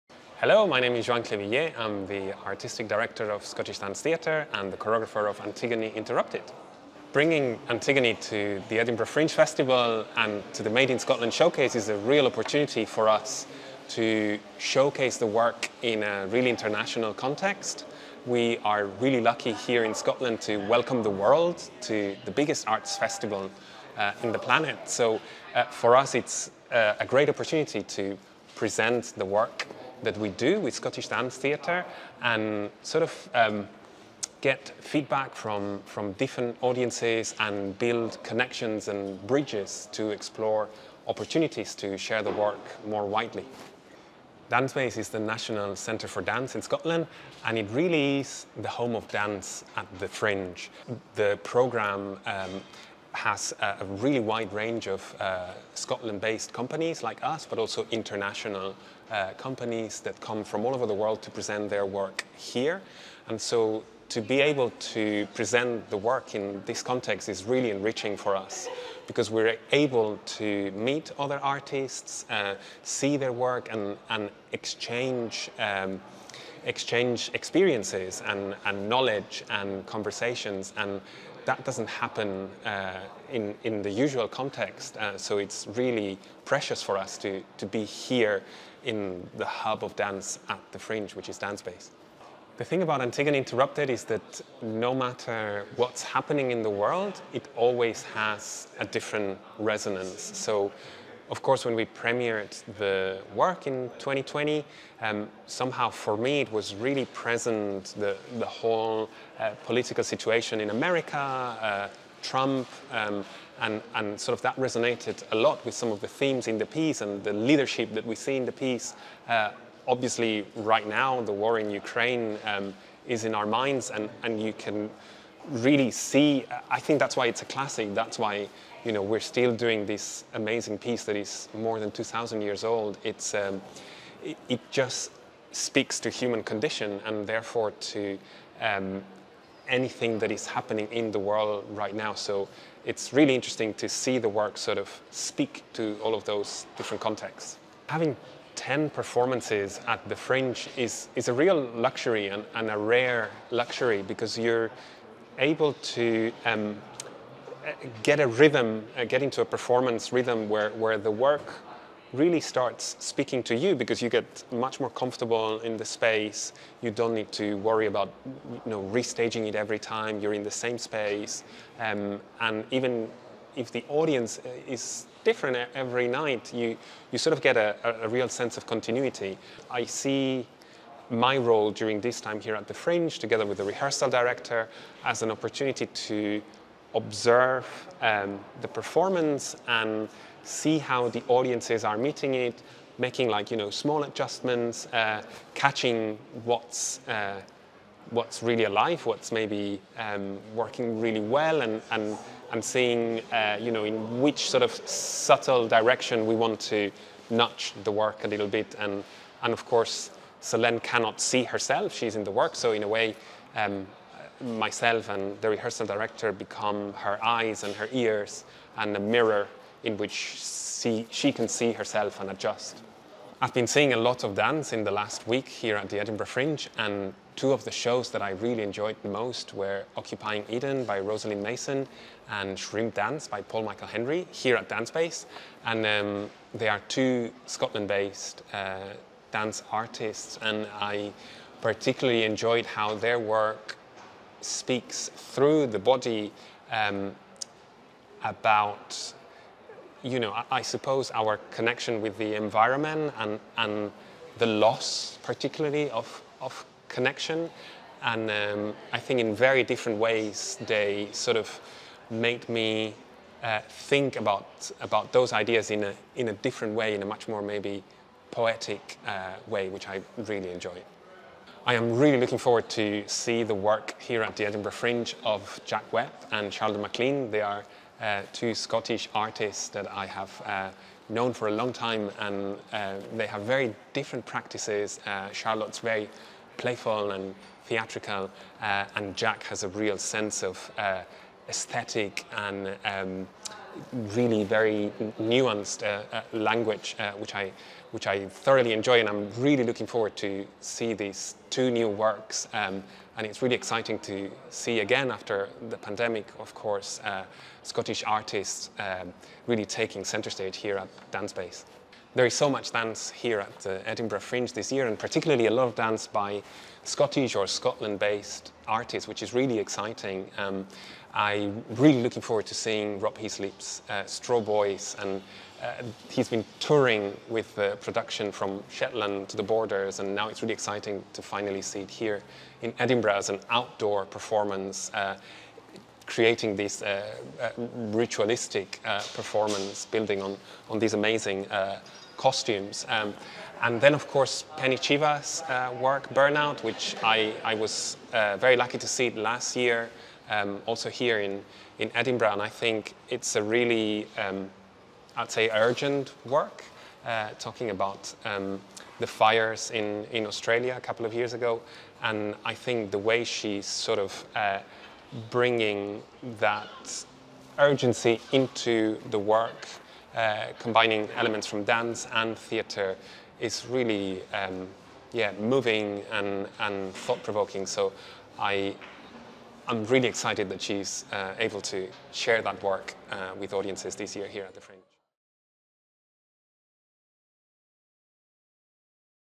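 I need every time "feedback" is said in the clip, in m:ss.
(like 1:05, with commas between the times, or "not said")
0:34.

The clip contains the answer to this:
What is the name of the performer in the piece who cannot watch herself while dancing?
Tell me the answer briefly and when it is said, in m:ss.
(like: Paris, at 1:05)
Solène, at 3:30.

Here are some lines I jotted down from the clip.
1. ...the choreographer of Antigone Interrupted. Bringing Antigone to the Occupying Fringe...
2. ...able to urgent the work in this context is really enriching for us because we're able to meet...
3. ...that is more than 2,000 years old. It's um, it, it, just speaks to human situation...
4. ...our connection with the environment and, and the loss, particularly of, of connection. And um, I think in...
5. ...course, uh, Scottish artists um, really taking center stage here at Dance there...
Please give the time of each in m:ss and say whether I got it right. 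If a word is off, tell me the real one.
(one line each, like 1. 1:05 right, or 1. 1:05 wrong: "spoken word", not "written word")
1. 0:04 wrong: "Edinburgh", not "Occupying"
2. 1:04 wrong: "present", not "urgent"
3. 2:11 wrong: "condition", not "situation"
4. 4:11 right
5. 5:06 right.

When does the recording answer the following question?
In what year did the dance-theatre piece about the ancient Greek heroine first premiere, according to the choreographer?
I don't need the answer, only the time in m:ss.
1:43.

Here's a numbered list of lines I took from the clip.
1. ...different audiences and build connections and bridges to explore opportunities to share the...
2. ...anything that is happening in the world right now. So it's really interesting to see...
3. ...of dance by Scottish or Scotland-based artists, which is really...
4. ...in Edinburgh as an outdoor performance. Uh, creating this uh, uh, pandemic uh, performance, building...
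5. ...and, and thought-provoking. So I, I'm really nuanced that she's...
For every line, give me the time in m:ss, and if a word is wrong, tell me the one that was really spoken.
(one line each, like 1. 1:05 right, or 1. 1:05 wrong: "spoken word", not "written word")
1. 0:36 right
2. 2:19 right
3. 5:15 right
4. 5:32 wrong: "ritualistic", not "pandemic"
5. 6:16 wrong: "excited", not "nuanced".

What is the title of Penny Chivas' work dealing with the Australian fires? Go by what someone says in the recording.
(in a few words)
Burnout.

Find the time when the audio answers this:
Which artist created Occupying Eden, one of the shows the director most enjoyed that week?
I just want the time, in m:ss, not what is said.
3:50.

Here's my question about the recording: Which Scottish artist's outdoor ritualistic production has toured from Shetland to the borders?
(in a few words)
Rob Heaslip.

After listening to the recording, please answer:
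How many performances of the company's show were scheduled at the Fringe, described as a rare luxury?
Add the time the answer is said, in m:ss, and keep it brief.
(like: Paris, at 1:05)
10, at 2:28.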